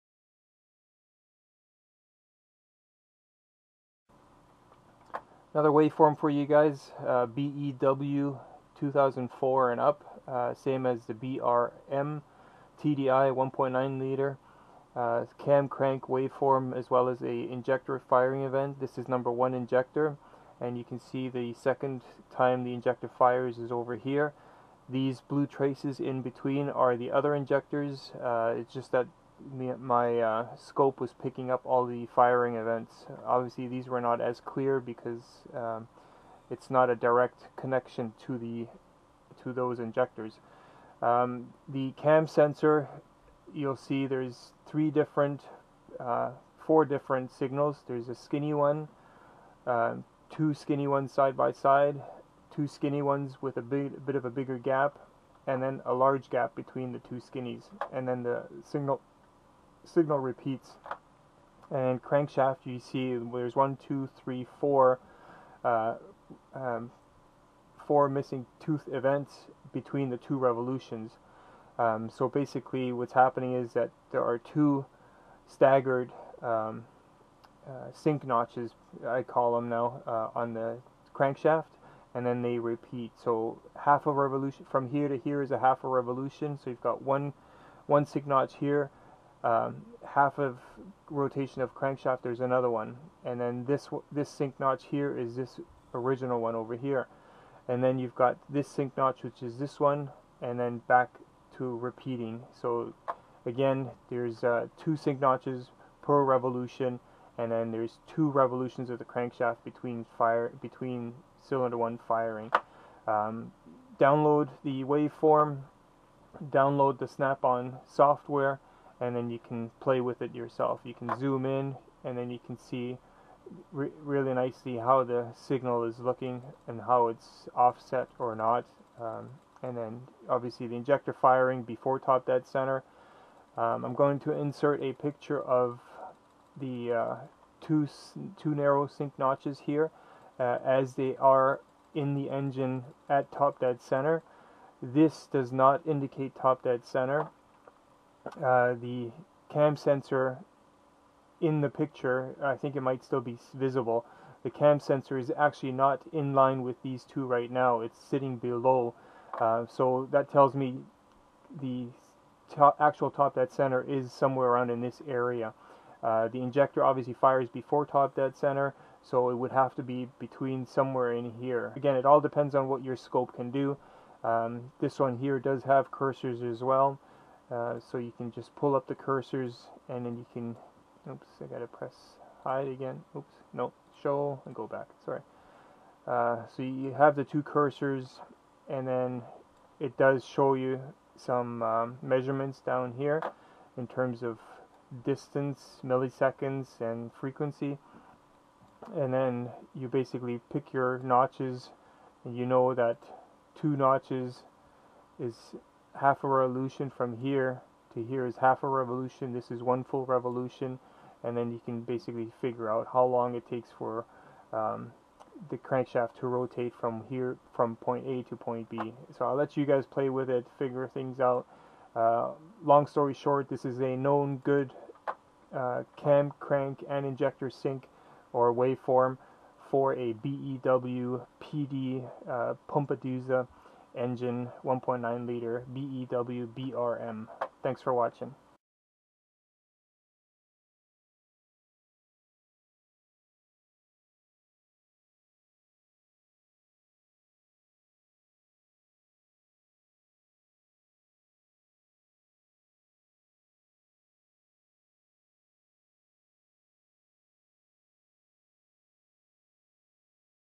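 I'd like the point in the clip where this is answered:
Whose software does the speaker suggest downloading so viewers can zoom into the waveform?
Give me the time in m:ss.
1:57.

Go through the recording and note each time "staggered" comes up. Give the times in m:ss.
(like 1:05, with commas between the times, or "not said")
1:15.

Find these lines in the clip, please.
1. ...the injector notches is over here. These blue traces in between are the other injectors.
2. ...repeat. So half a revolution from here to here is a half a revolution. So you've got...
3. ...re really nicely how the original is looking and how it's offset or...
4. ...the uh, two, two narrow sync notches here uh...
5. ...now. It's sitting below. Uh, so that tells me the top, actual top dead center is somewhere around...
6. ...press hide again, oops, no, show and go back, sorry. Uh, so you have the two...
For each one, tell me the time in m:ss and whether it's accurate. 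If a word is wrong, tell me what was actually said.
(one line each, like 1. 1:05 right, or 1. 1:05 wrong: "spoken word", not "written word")
1. 0:22 wrong: "fires", not "notches"
2. 1:22 right
3. 2:03 wrong: "signal", not "original"
4. 2:16 right
5. 2:37 right
6. 3:01 right.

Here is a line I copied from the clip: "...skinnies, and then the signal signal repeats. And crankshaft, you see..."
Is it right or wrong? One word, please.
right.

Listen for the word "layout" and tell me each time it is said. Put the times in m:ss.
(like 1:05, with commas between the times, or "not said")
not said.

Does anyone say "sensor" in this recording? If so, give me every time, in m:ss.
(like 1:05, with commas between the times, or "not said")
0:42, 2:29, 2:34.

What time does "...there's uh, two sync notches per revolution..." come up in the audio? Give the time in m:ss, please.
1:44.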